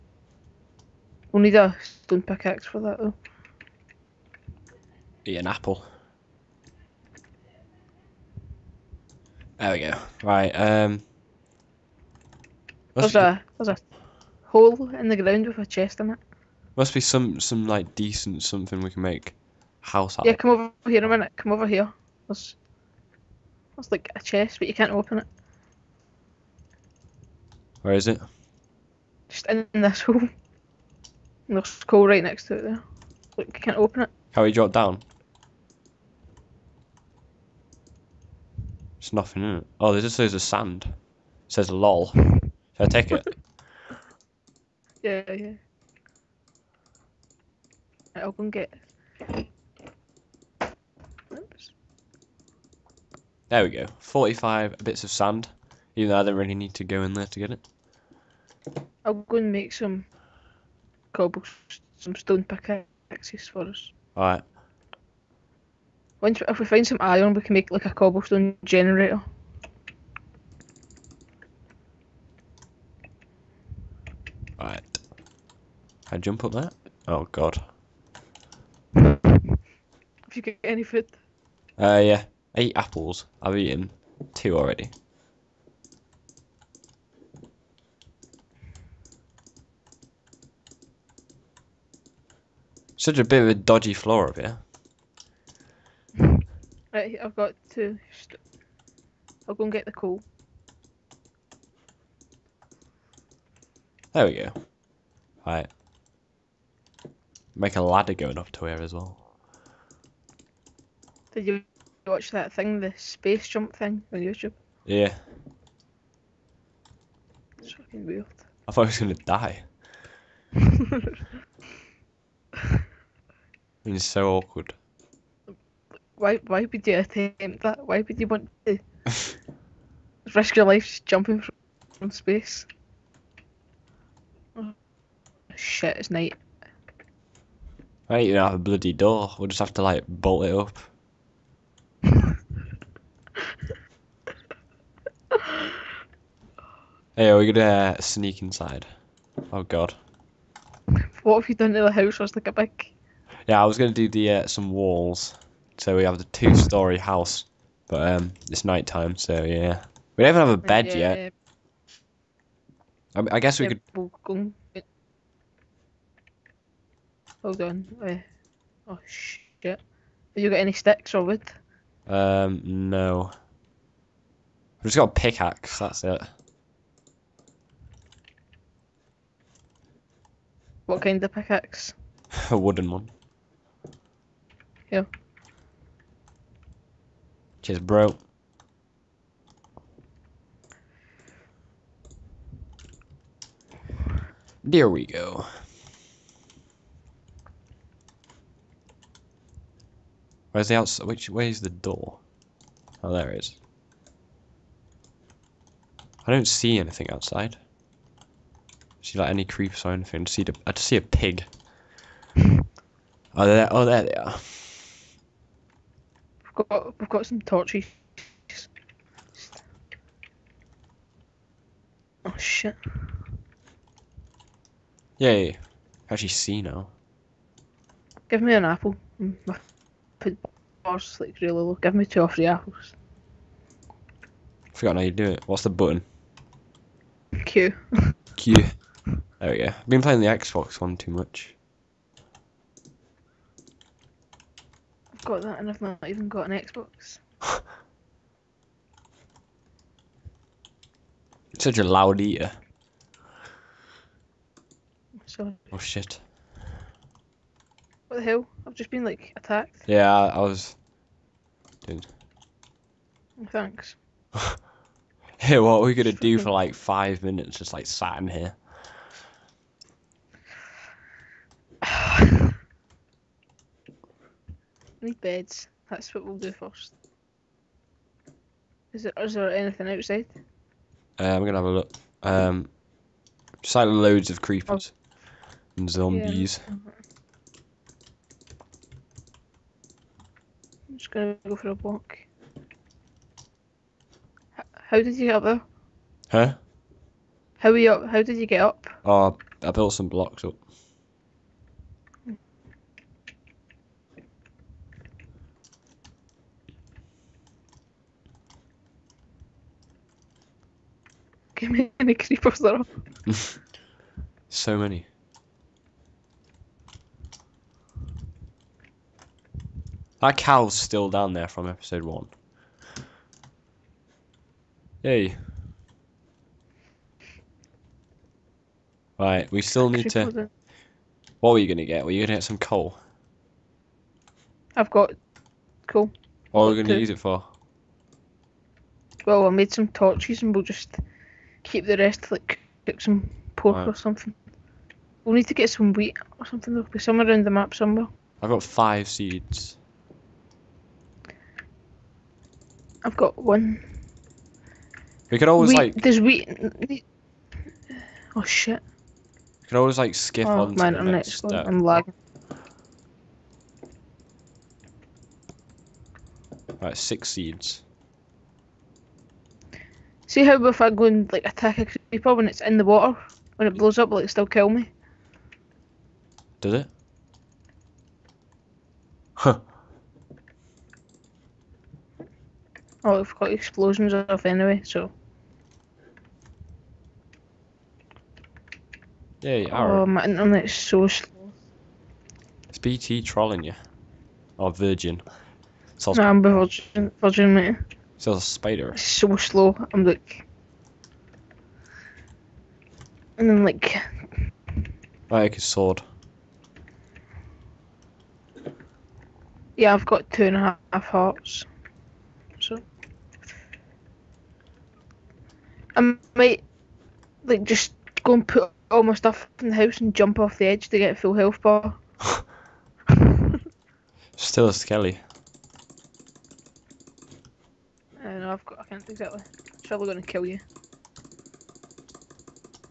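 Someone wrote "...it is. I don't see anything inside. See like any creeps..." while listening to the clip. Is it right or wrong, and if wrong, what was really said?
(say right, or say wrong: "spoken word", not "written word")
wrong: "outside", not "inside".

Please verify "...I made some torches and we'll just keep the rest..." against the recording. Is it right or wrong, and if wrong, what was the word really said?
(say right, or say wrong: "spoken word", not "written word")
right.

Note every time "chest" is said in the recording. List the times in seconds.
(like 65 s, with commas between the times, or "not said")
15 s, 24 s.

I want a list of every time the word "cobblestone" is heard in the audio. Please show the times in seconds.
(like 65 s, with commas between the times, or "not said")
61 s, 67 s.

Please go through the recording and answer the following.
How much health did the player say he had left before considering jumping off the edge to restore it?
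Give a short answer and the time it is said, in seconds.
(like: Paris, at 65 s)
2.5 hearts, at 410 s.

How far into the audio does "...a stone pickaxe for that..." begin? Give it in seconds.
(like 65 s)
1 s.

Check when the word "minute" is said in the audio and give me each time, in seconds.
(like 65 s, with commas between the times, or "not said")
21 s, 267 s.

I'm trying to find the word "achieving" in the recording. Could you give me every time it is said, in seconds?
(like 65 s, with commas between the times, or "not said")
not said.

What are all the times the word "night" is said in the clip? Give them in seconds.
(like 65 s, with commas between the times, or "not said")
136 s, 158 s.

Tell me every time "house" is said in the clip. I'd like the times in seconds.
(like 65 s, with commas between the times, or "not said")
19 s, 151 s, 156 s, 419 s.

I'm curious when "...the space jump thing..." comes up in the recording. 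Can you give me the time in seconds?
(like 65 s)
112 s.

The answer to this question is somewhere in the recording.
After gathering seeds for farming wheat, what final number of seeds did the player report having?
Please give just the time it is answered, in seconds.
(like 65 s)
366 s.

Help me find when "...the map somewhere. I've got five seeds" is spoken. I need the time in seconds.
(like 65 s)
347 s.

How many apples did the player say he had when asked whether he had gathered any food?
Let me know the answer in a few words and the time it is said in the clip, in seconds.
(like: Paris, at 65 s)
8, at 82 s.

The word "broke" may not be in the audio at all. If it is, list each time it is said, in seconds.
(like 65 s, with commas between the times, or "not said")
187 s.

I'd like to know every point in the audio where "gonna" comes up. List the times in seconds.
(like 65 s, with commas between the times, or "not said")
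118 s, 147 s, 265 s, 281 s, 291 s, 430 s.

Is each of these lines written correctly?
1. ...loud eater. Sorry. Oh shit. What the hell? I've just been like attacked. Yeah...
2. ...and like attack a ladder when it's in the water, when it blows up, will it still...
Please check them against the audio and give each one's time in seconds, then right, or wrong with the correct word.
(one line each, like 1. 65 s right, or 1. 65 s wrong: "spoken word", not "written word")
1. 251 s right
2. 371 s wrong: "creeper", not "ladder".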